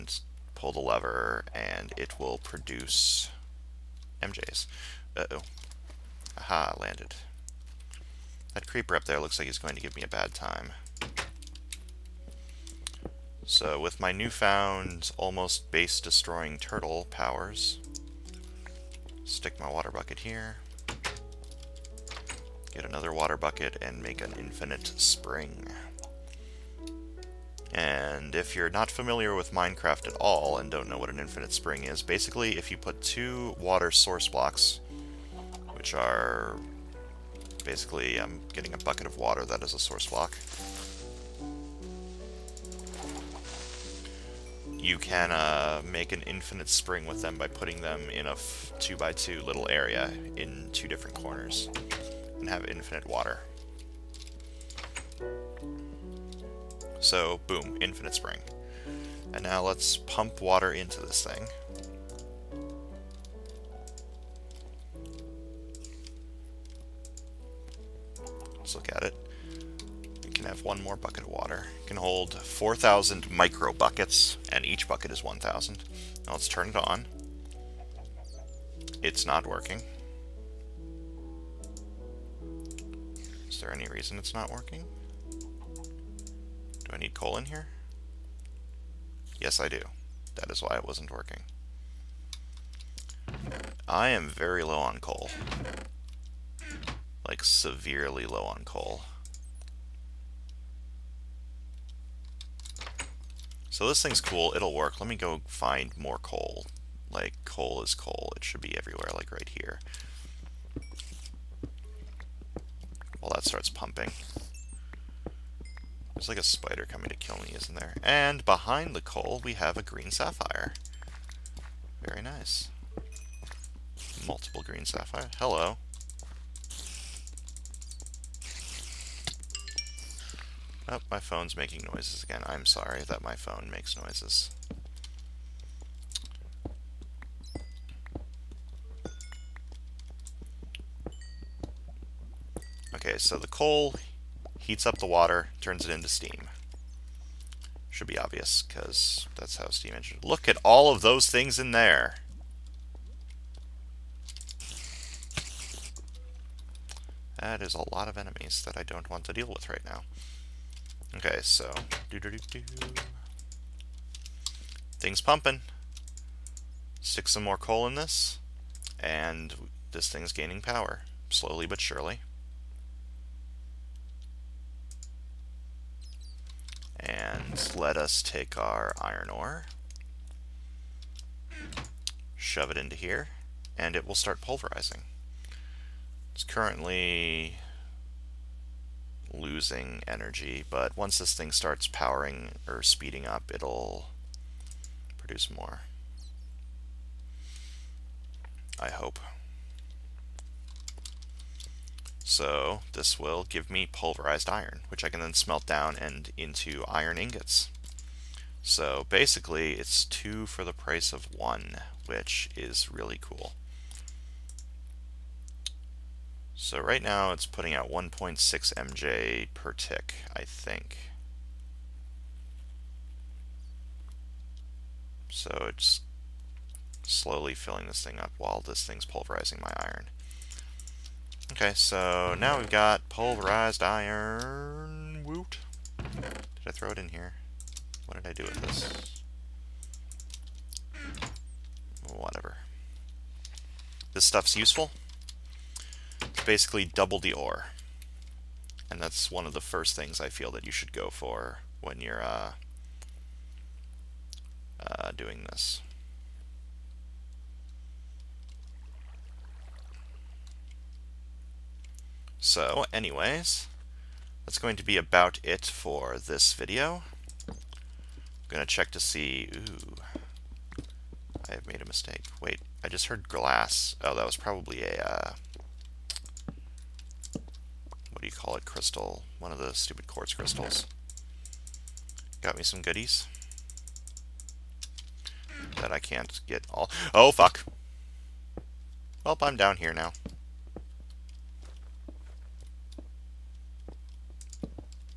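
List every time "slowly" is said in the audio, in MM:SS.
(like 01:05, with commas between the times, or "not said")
02:51, 03:47.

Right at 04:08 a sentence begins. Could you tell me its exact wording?
And that's one of the first things I feel that you should go for when you're uh, uh, doing this.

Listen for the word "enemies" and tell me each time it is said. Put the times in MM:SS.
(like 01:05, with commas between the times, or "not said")
02:38.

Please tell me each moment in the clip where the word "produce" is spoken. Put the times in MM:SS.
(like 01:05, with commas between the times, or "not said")
00:02, 03:15.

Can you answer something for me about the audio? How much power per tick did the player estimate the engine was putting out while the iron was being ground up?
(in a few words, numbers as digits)
1.6 MJ.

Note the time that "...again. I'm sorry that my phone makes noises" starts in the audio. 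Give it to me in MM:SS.
02:12.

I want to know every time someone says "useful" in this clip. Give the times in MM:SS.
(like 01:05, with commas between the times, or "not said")
04:04.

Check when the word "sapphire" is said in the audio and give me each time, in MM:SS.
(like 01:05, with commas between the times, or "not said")
02:00, 02:04.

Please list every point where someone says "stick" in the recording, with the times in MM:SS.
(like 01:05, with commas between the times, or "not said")
00:19, 02:46.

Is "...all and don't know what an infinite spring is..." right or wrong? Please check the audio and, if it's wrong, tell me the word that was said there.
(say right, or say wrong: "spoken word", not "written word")
right.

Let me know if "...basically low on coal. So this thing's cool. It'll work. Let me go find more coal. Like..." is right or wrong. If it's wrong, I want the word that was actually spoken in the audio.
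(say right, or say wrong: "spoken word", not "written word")
wrong: "severely", not "basically".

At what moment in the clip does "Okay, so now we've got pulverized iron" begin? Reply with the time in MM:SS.
03:51.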